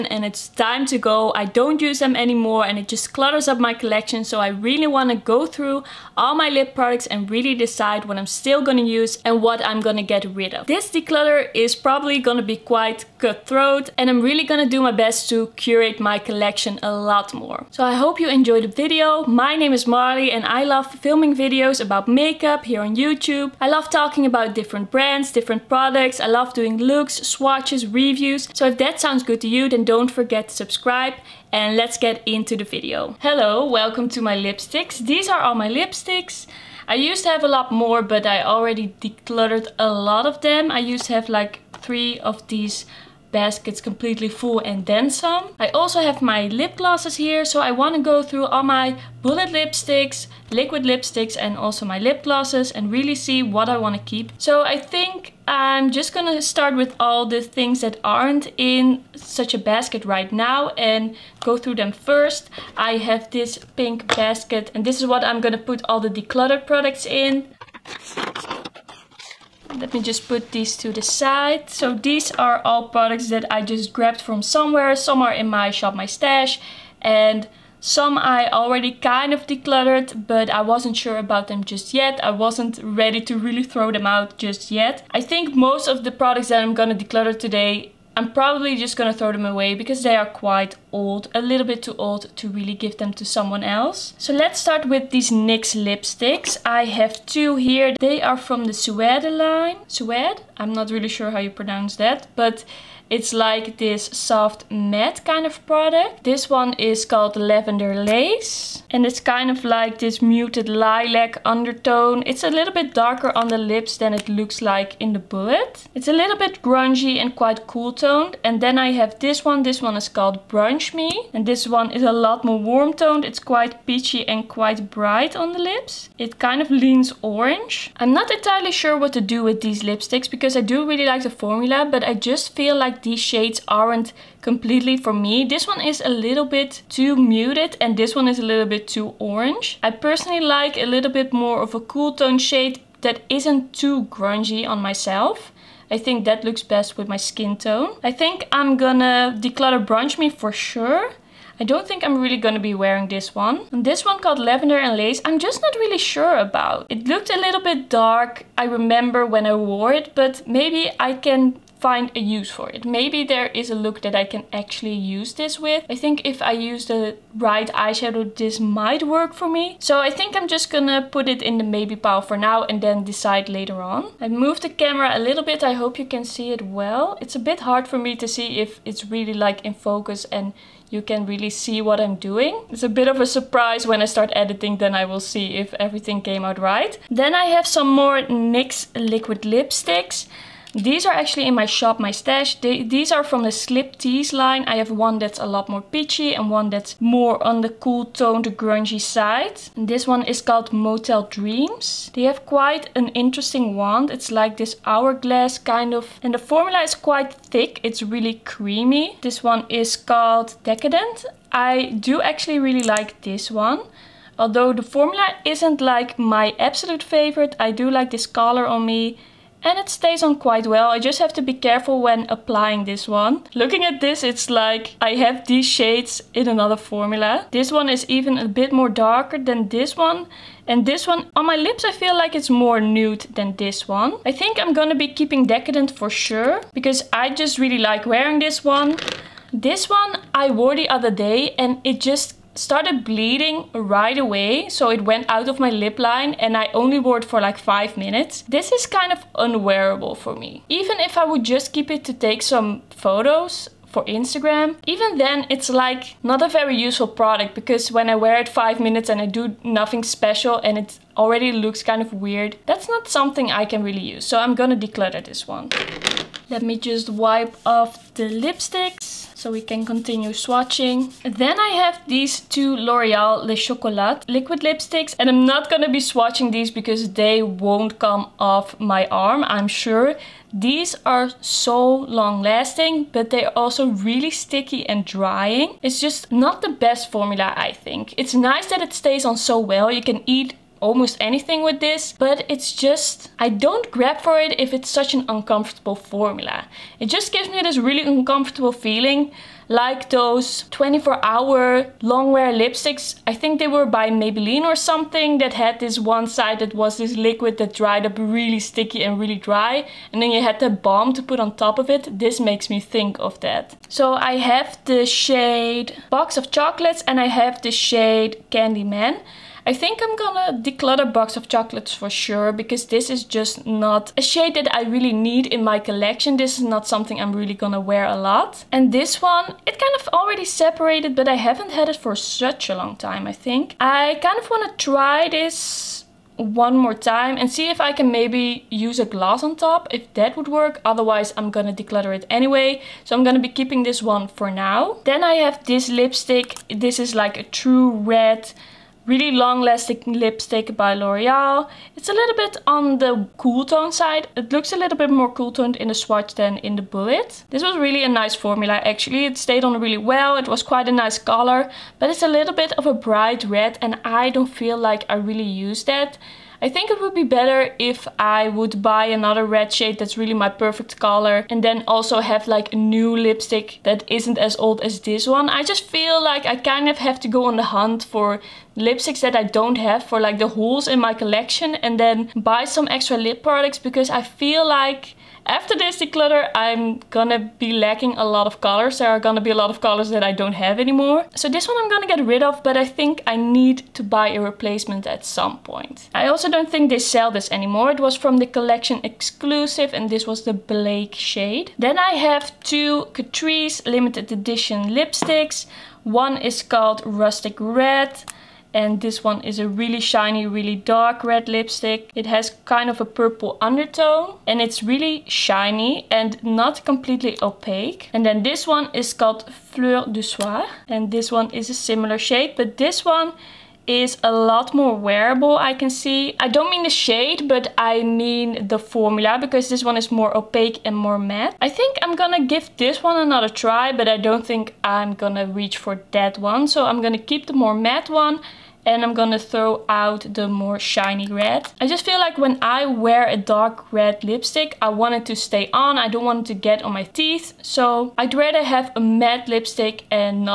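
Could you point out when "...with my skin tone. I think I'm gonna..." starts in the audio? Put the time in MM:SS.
02:26.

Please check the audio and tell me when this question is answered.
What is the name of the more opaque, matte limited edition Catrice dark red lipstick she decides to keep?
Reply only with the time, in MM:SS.
06:59.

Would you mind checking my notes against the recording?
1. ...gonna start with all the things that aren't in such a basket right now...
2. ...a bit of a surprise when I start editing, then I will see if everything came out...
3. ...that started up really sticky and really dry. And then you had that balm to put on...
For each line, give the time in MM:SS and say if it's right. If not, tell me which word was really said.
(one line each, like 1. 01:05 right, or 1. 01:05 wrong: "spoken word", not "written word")
1. 00:56 right
2. 03:02 right
3. 05:07 wrong: "dried", not "started".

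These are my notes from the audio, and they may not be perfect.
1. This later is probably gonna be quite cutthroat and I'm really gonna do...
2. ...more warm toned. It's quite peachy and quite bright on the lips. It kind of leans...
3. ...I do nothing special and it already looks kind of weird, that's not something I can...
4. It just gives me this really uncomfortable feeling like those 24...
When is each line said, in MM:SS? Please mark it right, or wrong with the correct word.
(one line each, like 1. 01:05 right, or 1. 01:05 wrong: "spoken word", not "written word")
1. 00:10 wrong: "declutter", not "later"
2. 02:02 right
3. 04:19 right
4. 04:56 right.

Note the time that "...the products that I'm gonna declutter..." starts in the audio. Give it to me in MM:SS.
01:26.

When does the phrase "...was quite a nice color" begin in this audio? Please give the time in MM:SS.
06:00.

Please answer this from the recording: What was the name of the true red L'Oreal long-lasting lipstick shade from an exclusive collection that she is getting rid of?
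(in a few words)
Blake.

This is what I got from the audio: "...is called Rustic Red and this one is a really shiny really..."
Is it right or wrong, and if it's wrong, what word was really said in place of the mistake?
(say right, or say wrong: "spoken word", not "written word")
right.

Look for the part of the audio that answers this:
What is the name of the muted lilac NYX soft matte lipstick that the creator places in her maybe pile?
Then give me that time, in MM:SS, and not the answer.
01:47.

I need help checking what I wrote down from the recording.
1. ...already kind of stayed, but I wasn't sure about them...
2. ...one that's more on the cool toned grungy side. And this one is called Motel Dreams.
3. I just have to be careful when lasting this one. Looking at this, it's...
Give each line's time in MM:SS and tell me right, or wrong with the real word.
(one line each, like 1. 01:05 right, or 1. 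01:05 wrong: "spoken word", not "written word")
1. 01:18 wrong: "decluttered", not "stayed"
2. 03:16 right
3. 03:40 wrong: "applying", not "lasting".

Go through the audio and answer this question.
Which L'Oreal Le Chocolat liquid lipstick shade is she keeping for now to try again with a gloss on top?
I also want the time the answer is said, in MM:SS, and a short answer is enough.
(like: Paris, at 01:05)
Candyman, at 05:18.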